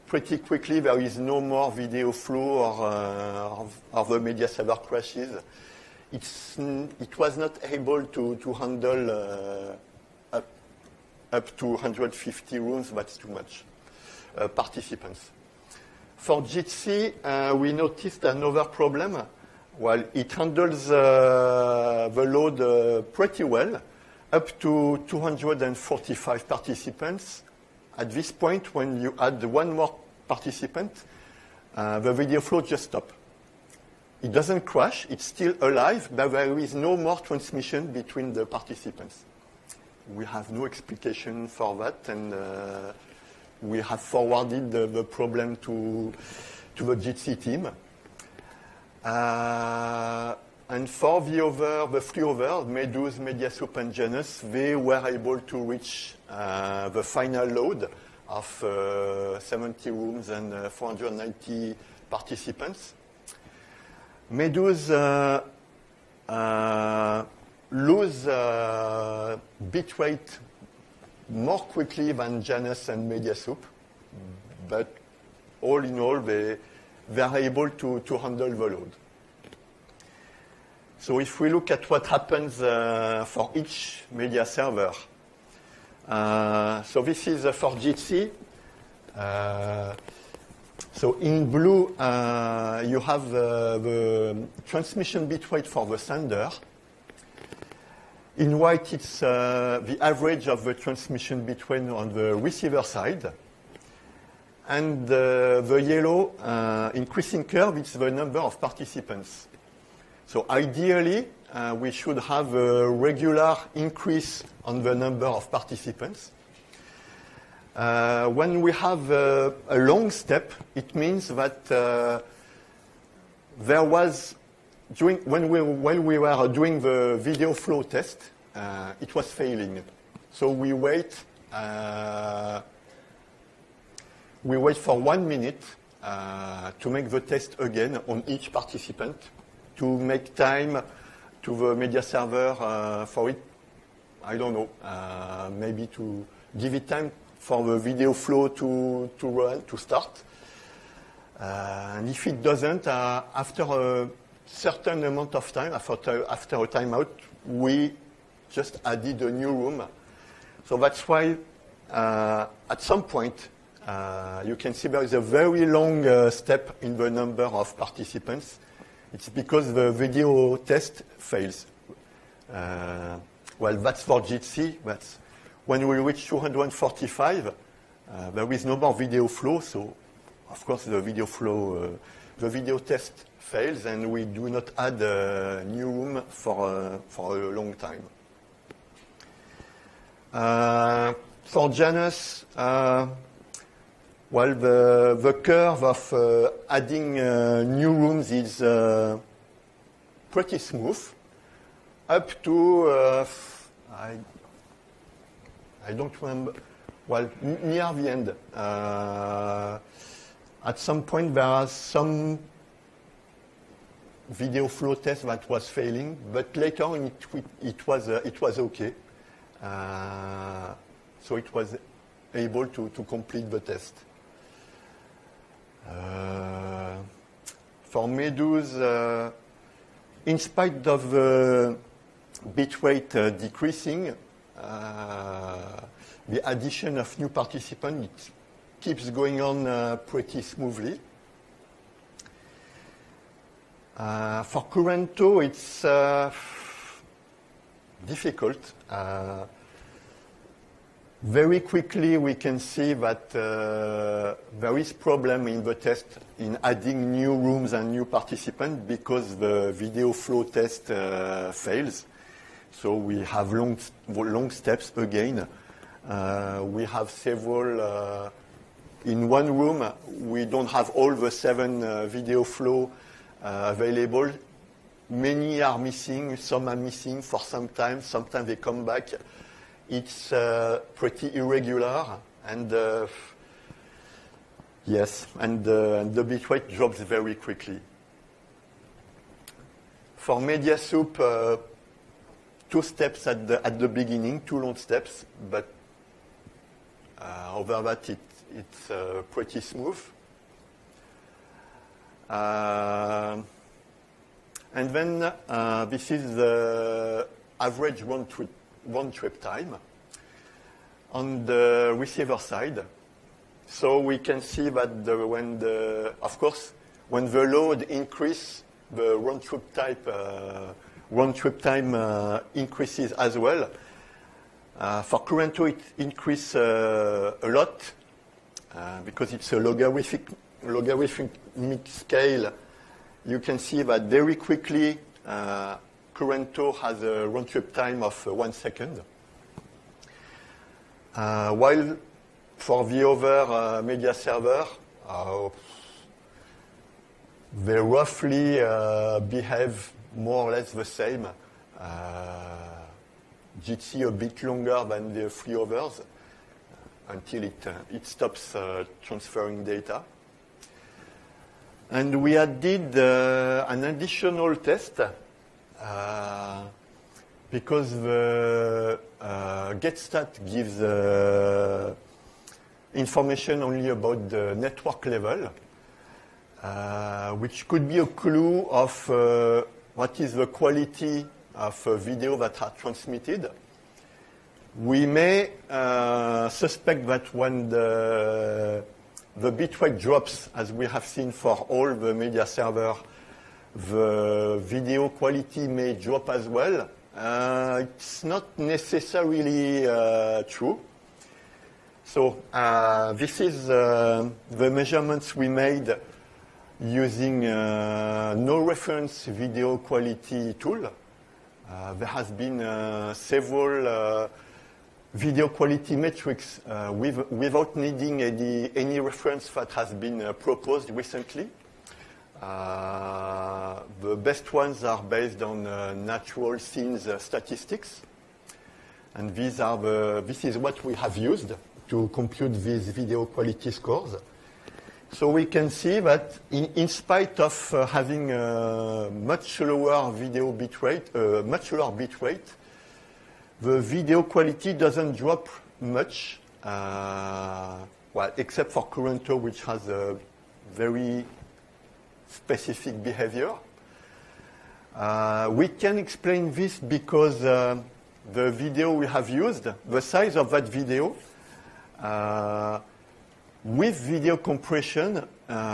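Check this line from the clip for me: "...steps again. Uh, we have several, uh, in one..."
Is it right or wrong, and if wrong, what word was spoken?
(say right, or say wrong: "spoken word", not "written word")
right.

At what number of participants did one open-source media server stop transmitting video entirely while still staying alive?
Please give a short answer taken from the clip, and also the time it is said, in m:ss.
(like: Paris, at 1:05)
245, at 0:25.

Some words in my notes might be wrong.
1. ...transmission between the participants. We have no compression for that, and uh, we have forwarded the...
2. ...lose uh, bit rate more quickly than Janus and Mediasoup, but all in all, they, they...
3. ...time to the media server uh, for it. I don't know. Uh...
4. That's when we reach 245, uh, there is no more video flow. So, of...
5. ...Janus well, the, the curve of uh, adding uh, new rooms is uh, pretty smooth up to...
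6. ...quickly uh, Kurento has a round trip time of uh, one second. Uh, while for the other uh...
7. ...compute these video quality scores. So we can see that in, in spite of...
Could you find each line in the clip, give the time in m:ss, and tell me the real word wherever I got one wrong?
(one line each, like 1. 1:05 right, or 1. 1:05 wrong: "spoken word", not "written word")
1. 0:37 wrong: "explication", not "compression"
2. 1:07 right
3. 2:20 right
4. 2:54 right
5. 3:11 right
6. 5:34 right
7. 7:12 right.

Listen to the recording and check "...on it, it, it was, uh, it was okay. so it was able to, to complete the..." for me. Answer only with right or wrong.
right.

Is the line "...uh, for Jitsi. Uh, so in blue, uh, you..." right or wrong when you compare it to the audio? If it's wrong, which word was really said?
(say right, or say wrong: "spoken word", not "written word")
right.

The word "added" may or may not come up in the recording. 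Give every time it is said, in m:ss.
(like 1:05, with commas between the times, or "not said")
2:38, 6:02.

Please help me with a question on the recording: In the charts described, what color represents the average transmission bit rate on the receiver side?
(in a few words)
White.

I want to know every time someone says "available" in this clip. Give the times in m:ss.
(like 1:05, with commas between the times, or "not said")
4:33.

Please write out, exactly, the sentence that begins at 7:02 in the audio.
Uh, the best ones are based on uh, natural scenes uh, statistics.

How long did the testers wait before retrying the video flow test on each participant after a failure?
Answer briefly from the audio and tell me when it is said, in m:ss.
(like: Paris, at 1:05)
One minute, at 2:14.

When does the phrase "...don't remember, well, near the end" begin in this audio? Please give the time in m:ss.
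3:25.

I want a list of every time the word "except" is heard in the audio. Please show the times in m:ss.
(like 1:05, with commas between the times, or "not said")
7:28.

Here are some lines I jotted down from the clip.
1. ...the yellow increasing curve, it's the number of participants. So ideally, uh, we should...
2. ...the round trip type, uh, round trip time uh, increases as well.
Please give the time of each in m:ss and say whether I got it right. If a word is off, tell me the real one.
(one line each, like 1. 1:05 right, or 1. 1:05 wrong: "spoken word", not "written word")
1. 1:45 right
2. 5:18 right.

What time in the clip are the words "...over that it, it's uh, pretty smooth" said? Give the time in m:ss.
4:57.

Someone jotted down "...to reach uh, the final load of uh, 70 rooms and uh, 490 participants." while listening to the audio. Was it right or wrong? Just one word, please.
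right.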